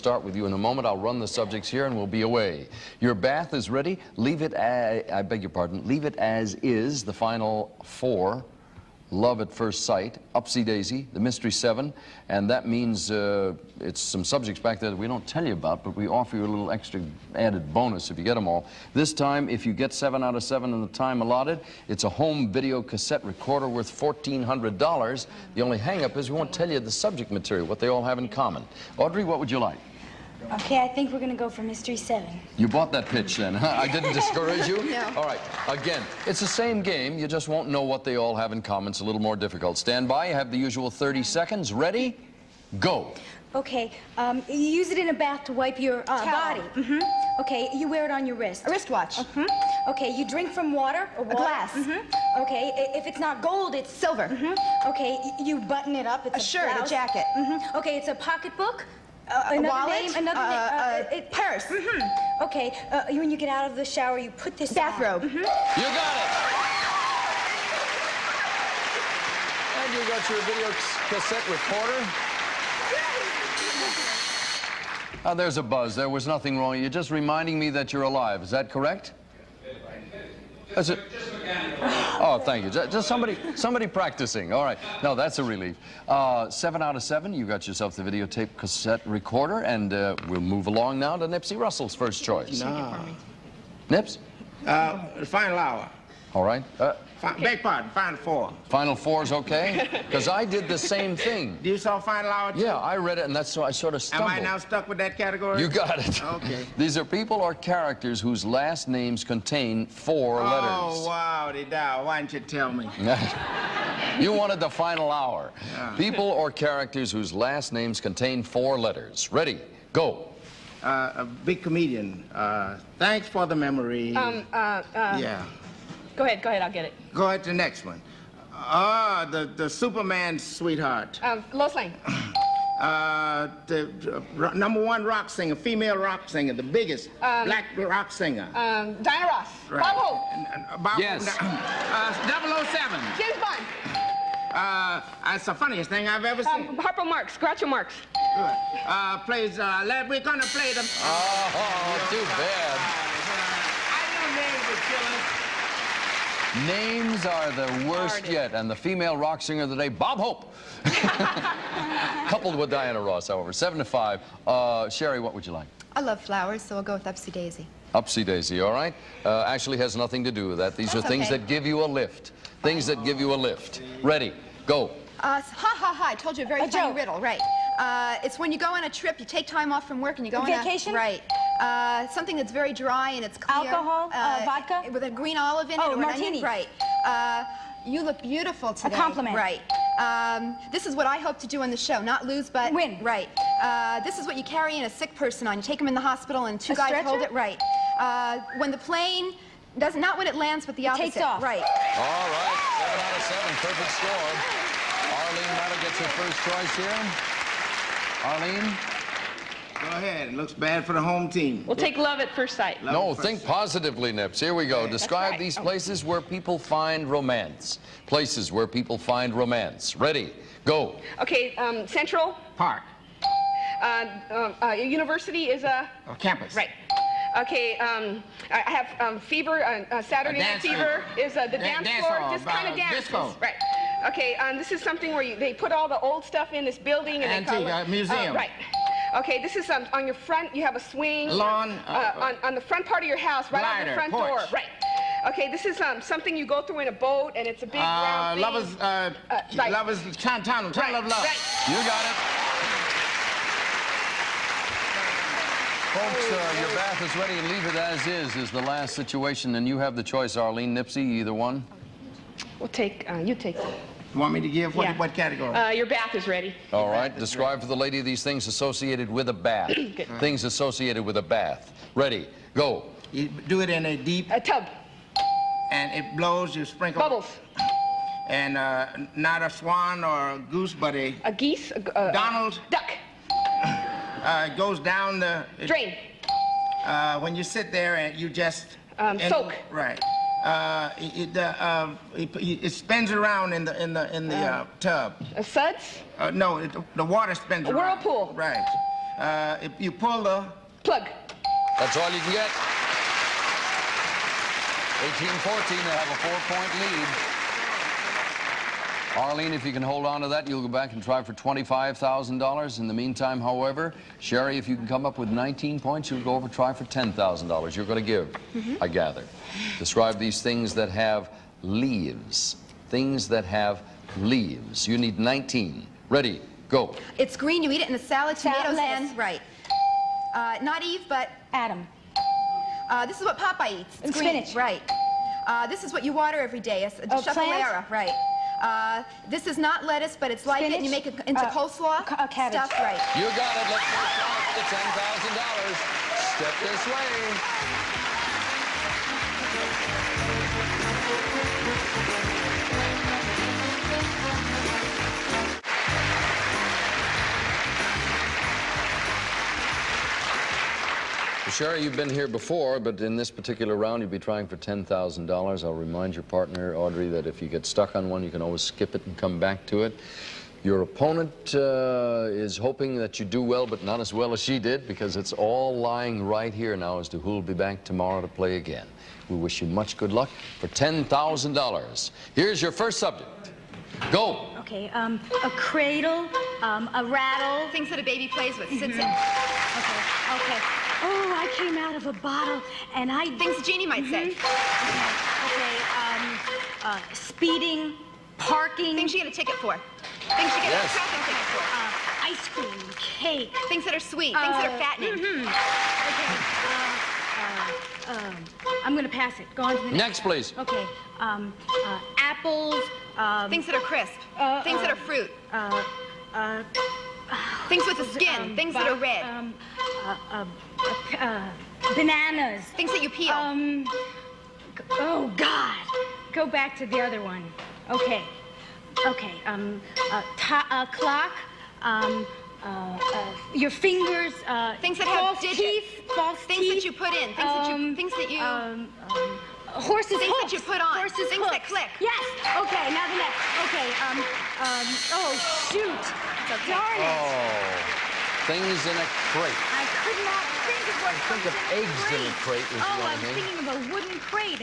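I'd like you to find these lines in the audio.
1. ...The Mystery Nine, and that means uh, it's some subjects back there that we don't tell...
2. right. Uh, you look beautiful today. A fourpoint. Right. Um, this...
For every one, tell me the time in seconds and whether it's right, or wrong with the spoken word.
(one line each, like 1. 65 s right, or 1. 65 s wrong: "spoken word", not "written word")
1. 11 s wrong: "Seven", not "Nine"
2. 186 s wrong: "compliment", not "fourpoint".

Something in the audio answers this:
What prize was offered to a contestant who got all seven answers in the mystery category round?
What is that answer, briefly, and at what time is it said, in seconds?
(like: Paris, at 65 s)
home video cassette recorder, at 22 s.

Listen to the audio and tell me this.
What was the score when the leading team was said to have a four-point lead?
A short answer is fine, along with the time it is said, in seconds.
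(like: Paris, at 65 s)
18-14, at 305 s.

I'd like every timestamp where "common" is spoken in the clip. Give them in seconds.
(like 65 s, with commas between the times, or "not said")
28 s, 38 s.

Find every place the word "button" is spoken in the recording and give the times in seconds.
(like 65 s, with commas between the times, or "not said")
55 s.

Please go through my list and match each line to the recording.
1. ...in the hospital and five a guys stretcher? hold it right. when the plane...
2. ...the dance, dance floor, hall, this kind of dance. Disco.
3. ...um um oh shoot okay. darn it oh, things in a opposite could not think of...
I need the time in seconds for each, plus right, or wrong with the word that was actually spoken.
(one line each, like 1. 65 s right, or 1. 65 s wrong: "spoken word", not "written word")
1. 195 s wrong: "two", not "five"
2. 231 s right
3. 444 s wrong: "crate", not "opposite".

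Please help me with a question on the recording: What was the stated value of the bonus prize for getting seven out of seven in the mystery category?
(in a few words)
$1,400.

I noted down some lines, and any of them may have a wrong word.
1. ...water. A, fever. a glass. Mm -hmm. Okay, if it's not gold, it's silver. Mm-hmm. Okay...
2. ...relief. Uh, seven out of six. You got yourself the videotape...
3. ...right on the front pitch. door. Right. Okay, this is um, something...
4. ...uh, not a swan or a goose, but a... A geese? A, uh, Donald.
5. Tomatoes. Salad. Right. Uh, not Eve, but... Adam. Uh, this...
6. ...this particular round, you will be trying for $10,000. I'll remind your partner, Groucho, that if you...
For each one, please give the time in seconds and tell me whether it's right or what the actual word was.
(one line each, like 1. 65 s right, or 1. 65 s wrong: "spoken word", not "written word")
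1. 50 s wrong: "water", not "fever"
2. 85 s wrong: "seven", not "six"
3. 243 s wrong: "porch", not "pitch"
4. 278 s right
5. 328 s right
6. 363 s wrong: "Audrey", not "Groucho".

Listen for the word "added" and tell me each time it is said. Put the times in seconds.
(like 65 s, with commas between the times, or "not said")
17 s.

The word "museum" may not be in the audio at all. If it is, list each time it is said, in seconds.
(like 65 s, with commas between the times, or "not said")
237 s.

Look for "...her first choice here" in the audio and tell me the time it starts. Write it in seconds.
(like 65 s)
206 s.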